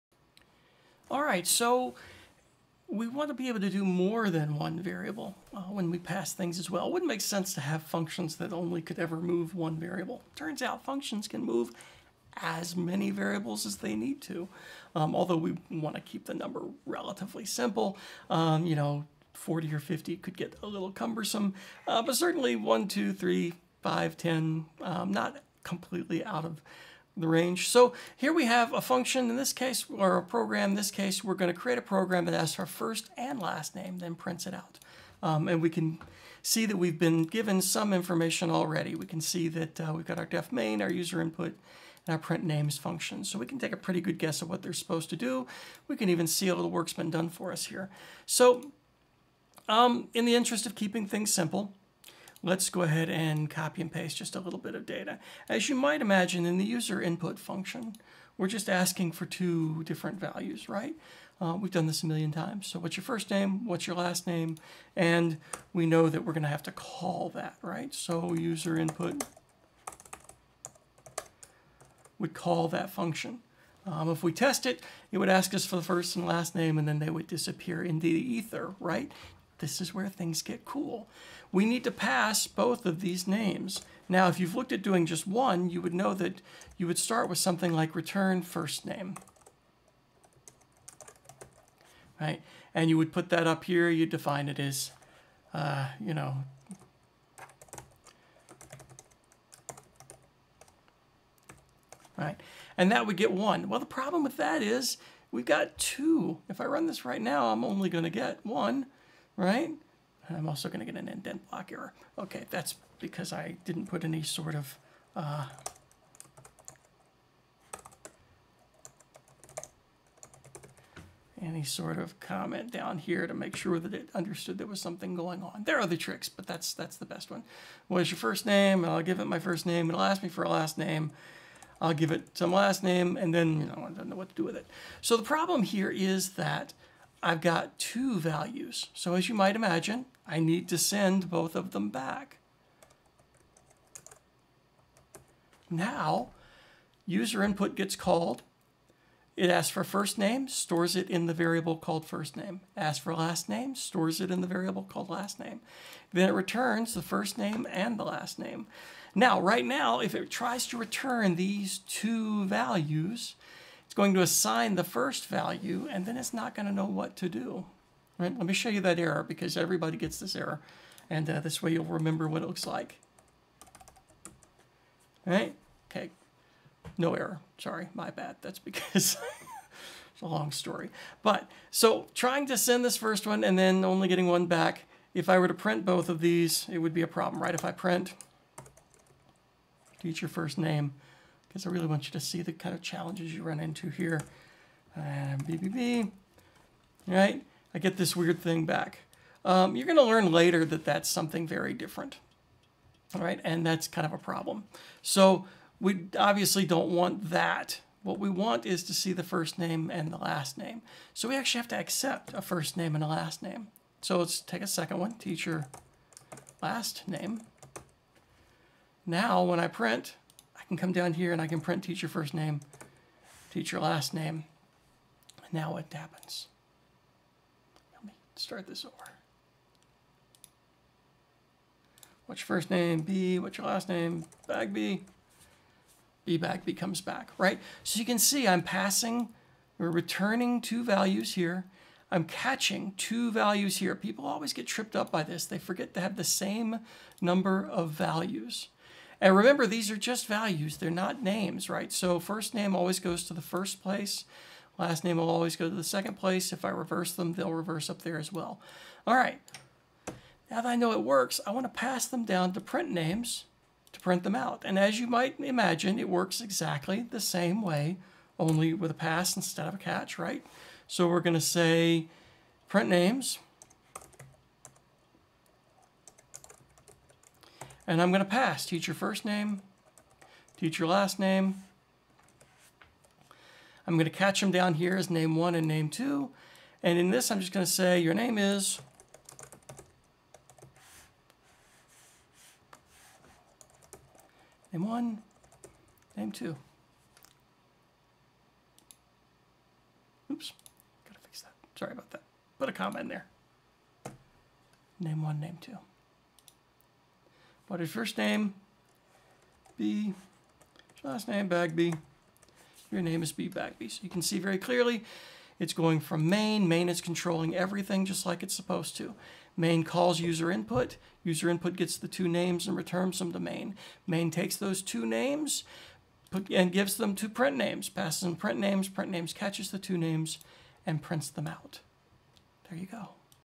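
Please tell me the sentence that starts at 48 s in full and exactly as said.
So um, in the interest of keeping things simple, Let's go ahead and copy and paste just a little bit of data.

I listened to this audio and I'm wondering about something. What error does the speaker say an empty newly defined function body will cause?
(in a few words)
indent block error.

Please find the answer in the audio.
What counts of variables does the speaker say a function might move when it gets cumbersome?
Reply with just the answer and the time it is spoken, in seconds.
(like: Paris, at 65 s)
40 or 50, at 19 s.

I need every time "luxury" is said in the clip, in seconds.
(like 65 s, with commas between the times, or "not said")
not said.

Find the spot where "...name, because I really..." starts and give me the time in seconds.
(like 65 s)
190 s.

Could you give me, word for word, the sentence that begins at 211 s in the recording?
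So we actually have to accept a first name and a last name.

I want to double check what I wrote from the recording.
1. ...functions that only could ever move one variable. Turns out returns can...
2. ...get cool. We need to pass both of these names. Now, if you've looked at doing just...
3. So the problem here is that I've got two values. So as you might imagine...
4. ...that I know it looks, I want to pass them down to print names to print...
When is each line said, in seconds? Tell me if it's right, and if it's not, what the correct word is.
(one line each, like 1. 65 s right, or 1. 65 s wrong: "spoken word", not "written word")
1. 7 s wrong: "functions", not "returns"
2. 80 s right
3. 135 s right
4. 260 s wrong: "works", not "looks".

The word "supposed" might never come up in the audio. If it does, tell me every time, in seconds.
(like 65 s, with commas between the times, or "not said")
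44 s, 318 s.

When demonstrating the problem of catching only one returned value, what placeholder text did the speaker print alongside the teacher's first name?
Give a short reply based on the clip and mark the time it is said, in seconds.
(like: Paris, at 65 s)
BBB, at 195 s.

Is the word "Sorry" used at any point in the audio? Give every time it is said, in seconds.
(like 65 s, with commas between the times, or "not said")
177 s, 301 s.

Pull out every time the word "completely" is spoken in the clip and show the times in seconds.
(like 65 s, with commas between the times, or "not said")
25 s.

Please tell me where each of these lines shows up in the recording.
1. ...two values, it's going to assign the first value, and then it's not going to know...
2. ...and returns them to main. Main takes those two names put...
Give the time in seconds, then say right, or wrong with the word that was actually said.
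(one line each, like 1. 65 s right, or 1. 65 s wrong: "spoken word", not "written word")
1. 161 s right
2. 322 s right.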